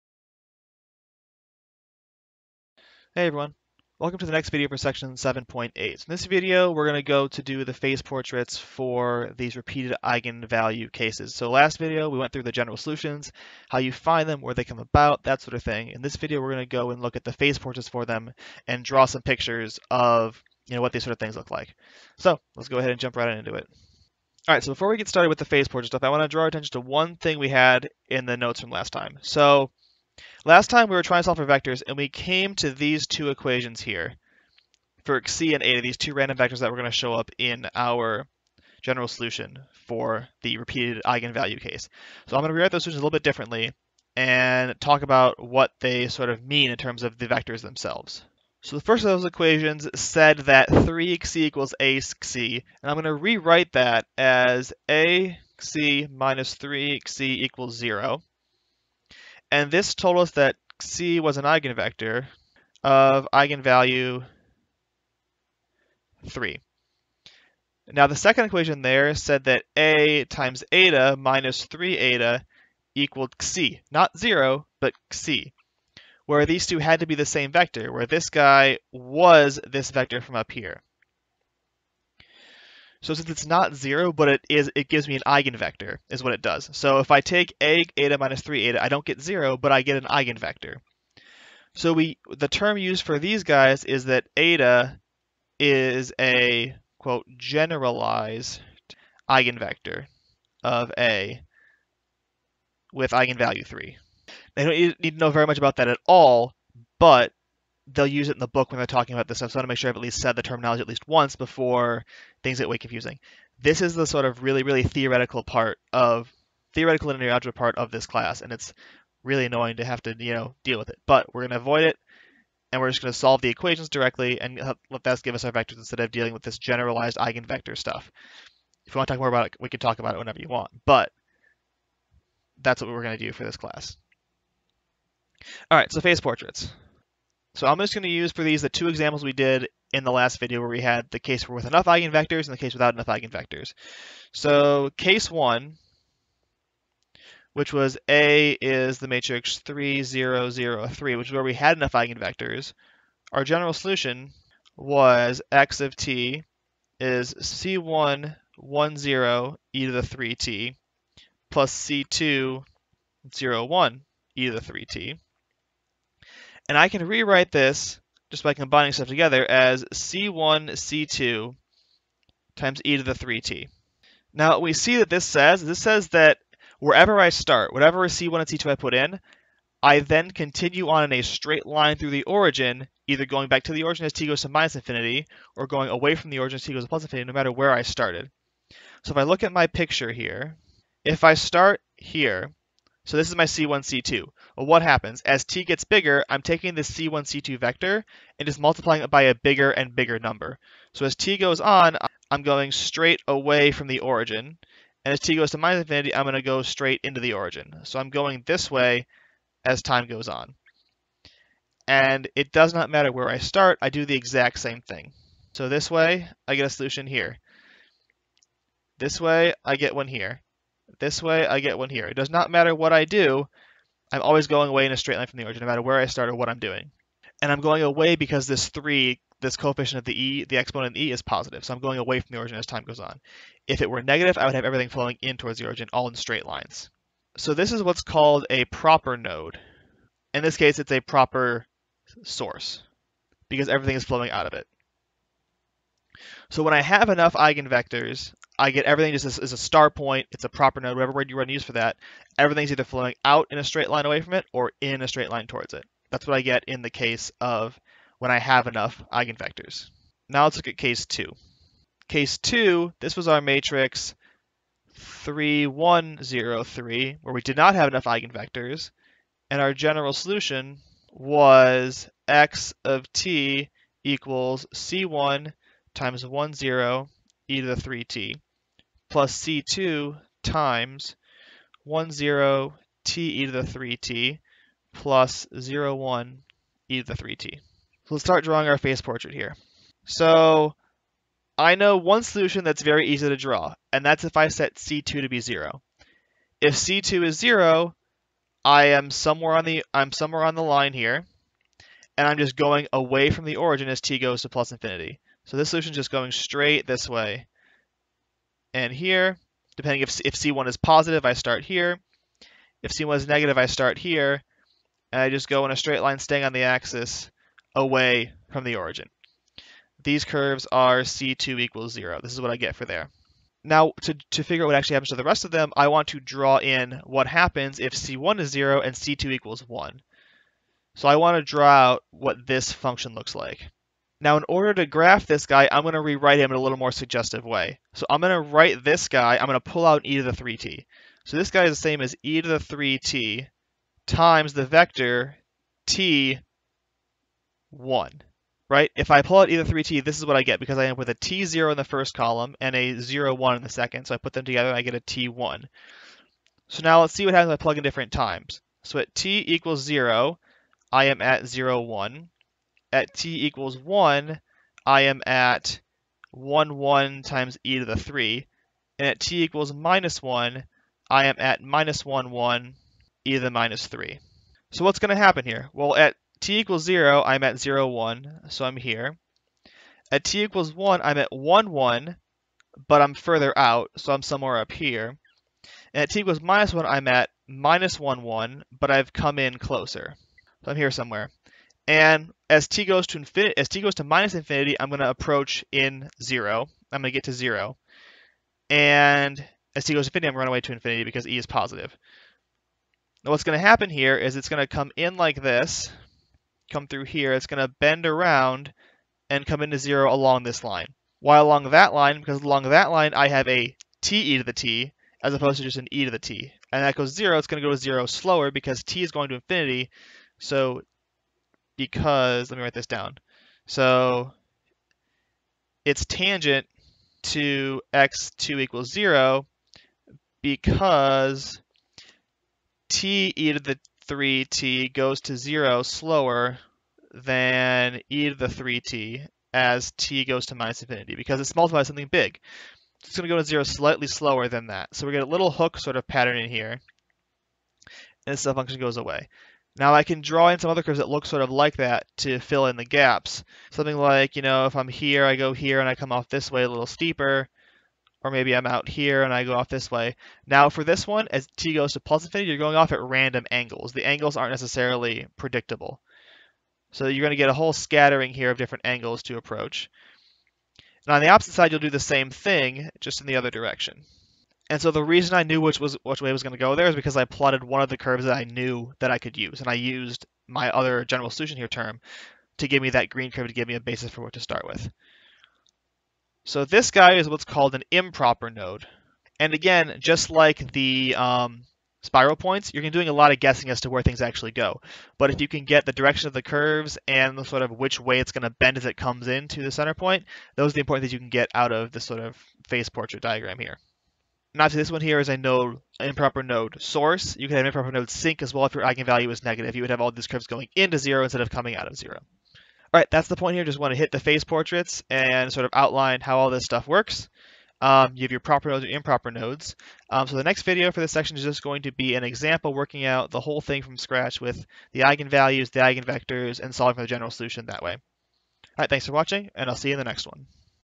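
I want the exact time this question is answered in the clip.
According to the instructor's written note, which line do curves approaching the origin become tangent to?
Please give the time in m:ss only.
7:07.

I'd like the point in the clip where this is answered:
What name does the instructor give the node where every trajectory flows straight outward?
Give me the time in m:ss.
4:01.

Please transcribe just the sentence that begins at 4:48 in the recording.
So let's start drawing our phase portrait here.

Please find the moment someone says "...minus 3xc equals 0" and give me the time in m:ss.
0:56.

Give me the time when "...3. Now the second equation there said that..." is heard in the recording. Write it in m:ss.
1:06.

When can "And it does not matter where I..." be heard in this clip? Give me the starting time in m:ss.
3:31.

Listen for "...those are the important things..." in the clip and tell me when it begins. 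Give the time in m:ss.
8:20.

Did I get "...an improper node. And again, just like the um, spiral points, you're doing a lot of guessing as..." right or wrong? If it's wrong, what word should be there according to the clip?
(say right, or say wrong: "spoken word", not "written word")
right.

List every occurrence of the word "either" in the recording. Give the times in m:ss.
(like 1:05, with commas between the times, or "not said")
3:03, 4:12.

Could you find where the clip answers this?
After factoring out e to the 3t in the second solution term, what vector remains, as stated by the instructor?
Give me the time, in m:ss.
5:45.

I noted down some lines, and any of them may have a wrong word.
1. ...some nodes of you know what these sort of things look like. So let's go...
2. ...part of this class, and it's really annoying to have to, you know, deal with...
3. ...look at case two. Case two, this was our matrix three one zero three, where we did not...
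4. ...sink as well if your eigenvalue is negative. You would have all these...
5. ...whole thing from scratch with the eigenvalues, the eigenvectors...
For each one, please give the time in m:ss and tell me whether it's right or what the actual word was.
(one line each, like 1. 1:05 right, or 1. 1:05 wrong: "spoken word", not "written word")
1. 0:19 wrong: "pictures", not "nodes"
2. 1:57 right
3. 4:20 right
4. 8:28 right
5. 8:43 right.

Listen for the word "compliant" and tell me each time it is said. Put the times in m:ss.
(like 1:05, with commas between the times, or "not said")
not said.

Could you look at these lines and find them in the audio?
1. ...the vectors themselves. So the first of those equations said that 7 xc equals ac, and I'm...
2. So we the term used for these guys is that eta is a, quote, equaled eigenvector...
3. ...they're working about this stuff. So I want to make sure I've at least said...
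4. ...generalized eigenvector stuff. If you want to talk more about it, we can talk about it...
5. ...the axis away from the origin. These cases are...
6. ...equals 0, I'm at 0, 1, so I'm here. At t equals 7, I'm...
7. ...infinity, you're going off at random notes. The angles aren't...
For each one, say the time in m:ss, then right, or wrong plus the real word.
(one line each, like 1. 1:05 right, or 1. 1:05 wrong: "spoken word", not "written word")
1. 0:47 wrong: "3", not "7"
2. 1:31 wrong: "generalized", not "equaled"
3. 1:48 wrong: "talking", not "working"
4. 2:06 right
5. 5:16 wrong: "curves", not "cases"
6. 6:16 wrong: "1", not "7"
7. 7:42 wrong: "angles", not "notes".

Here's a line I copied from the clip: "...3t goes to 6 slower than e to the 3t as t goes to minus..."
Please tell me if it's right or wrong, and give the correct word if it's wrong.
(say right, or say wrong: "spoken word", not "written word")
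wrong: "0", not "6".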